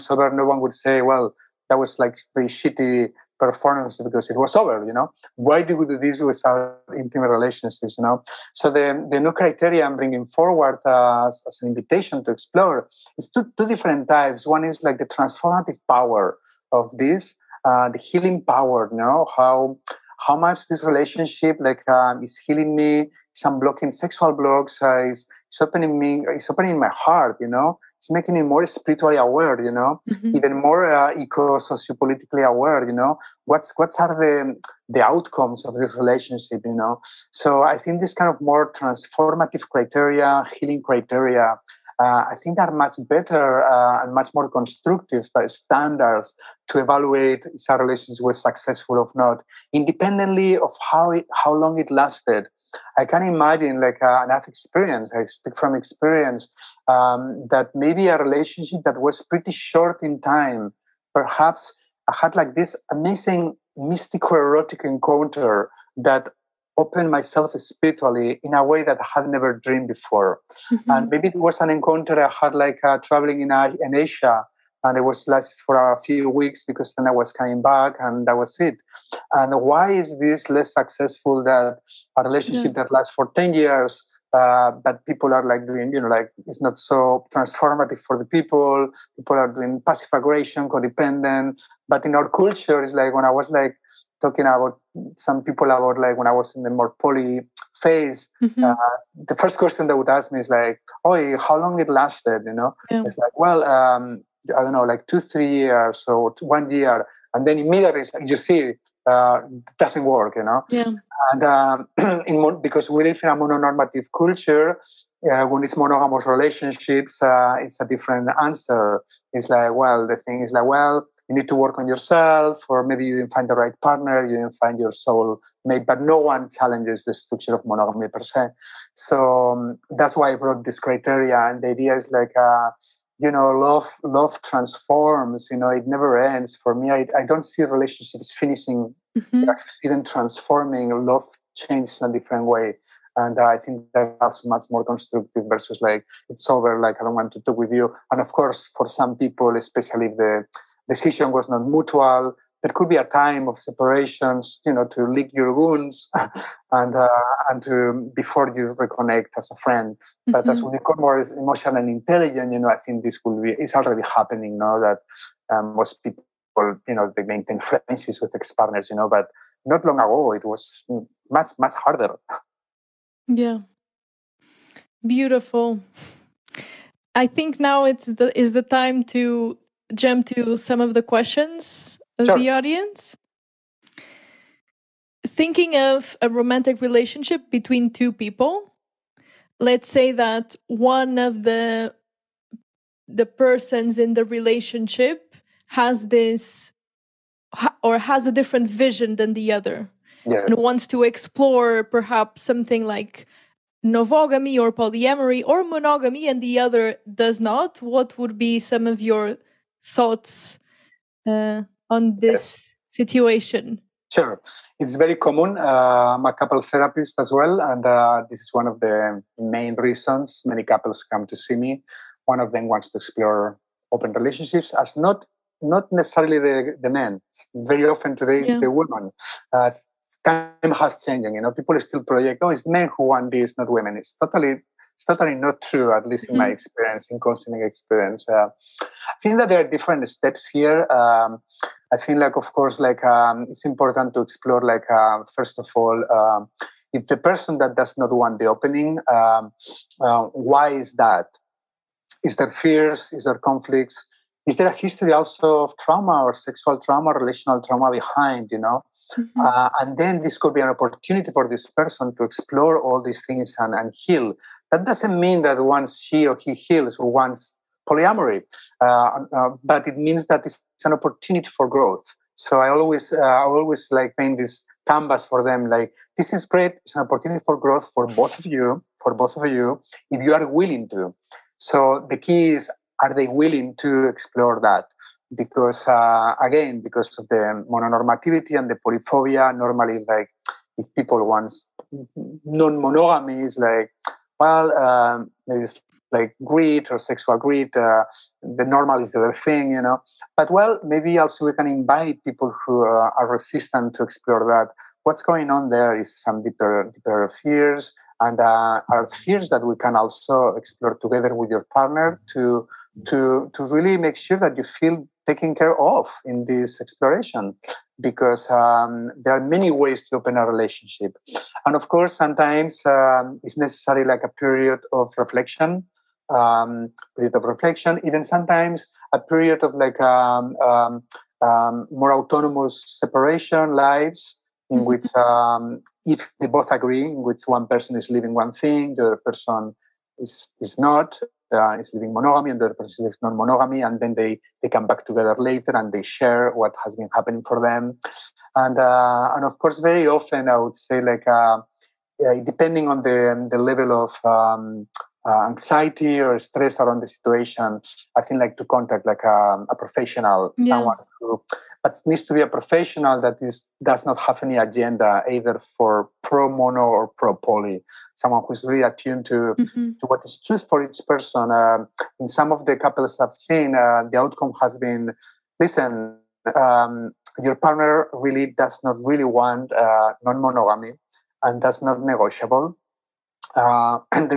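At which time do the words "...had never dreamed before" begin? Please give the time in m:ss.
1:09.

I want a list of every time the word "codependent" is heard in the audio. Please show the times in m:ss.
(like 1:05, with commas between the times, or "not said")
1:30.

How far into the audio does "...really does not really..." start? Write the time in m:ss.
6:18.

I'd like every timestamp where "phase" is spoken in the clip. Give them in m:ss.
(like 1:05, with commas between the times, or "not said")
1:37.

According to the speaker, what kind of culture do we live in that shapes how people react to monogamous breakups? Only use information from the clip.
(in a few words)
mononormative.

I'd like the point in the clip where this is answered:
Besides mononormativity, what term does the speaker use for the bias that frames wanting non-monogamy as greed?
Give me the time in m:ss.
4:48.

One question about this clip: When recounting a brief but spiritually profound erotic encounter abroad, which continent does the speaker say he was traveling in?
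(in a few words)
Asia.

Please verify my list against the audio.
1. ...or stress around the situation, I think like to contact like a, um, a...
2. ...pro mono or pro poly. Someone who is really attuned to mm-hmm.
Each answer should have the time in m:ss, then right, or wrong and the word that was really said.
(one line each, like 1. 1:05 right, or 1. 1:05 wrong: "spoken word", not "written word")
1. 5:56 right
2. 6:06 right.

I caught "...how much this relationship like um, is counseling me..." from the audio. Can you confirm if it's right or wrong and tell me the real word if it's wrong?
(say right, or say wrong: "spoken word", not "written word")
wrong: "healing", not "counseling".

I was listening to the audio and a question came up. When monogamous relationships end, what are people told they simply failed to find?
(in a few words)
soul mate.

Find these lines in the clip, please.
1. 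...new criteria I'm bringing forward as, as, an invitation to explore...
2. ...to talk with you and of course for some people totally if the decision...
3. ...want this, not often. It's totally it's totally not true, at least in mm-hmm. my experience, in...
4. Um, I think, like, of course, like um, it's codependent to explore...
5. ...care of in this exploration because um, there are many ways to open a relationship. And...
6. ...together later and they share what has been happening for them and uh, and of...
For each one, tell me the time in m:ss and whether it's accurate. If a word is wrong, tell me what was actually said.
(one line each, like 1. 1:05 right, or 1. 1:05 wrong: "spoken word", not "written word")
1. 0:09 right
2. 2:27 wrong: "especially", not "totally"
3. 3:53 wrong: "women", not "often"
4. 4:00 wrong: "important", not "codependent"
5. 5:15 right
6. 5:45 right.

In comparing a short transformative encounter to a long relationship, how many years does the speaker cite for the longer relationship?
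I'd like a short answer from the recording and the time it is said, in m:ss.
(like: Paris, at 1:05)
10, at 1:23.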